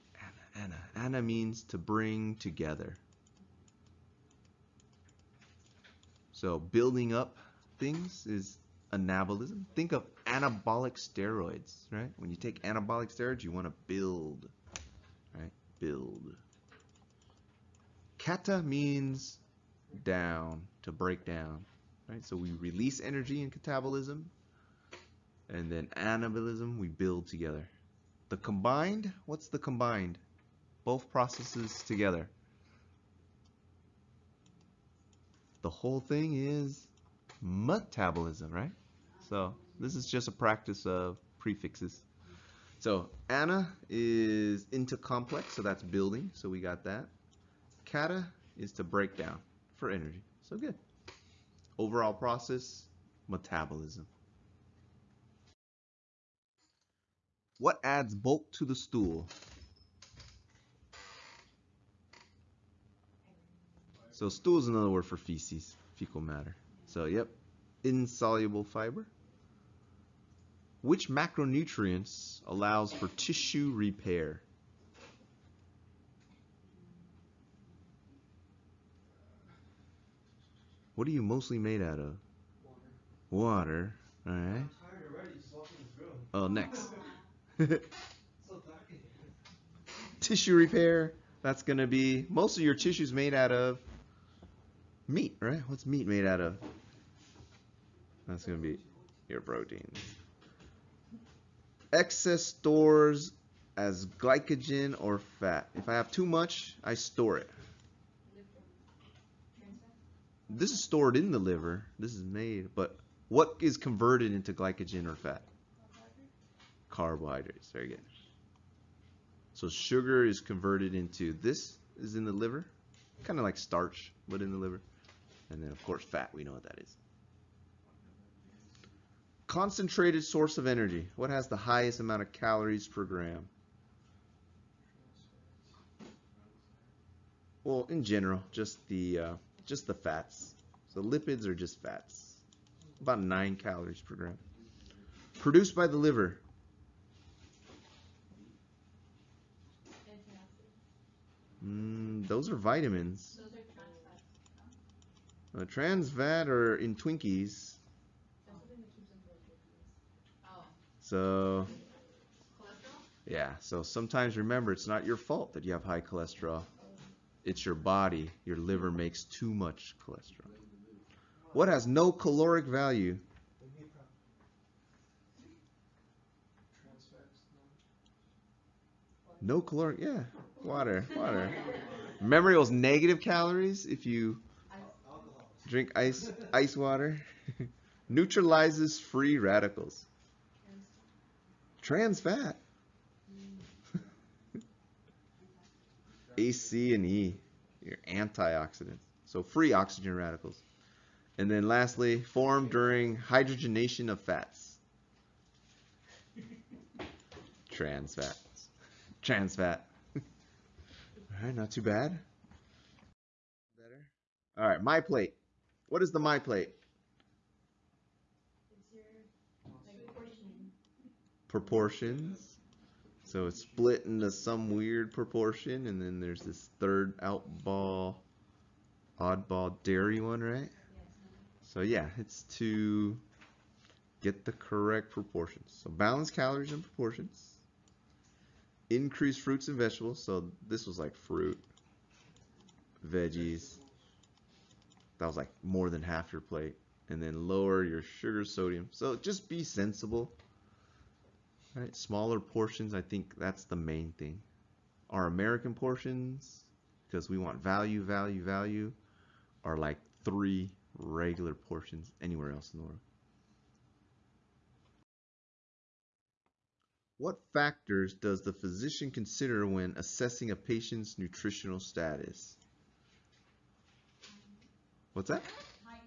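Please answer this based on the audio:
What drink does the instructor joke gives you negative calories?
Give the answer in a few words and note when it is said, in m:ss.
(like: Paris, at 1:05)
Ice water, at 3:05.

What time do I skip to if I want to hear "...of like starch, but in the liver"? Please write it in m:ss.
2:03.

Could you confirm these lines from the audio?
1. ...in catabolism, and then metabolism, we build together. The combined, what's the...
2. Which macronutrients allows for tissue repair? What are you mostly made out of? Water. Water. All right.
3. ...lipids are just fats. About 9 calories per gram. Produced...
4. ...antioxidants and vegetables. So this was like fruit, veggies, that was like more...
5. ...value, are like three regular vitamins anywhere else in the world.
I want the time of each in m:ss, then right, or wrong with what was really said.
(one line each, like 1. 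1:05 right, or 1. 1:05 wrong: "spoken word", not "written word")
1. 0:23 wrong: "anabolism", not "metabolism"
2. 1:10 right
3. 2:21 right
4. 3:59 wrong: "fruits", not "antioxidants"
5. 4:18 wrong: "portions", not "vitamins".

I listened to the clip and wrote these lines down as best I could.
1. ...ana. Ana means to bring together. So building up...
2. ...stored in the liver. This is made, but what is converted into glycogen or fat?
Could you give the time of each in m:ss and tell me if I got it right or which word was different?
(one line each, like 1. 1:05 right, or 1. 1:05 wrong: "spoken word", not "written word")
1. 0:00 right
2. 1:50 right.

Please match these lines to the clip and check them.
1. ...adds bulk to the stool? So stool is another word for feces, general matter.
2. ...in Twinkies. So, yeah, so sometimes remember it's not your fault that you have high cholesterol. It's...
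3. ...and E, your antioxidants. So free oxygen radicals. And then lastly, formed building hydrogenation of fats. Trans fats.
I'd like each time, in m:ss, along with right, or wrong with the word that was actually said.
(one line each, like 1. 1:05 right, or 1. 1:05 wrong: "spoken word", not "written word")
1. 0:57 wrong: "fecal", not "general"
2. 2:36 right
3. 3:16 wrong: "during", not "building".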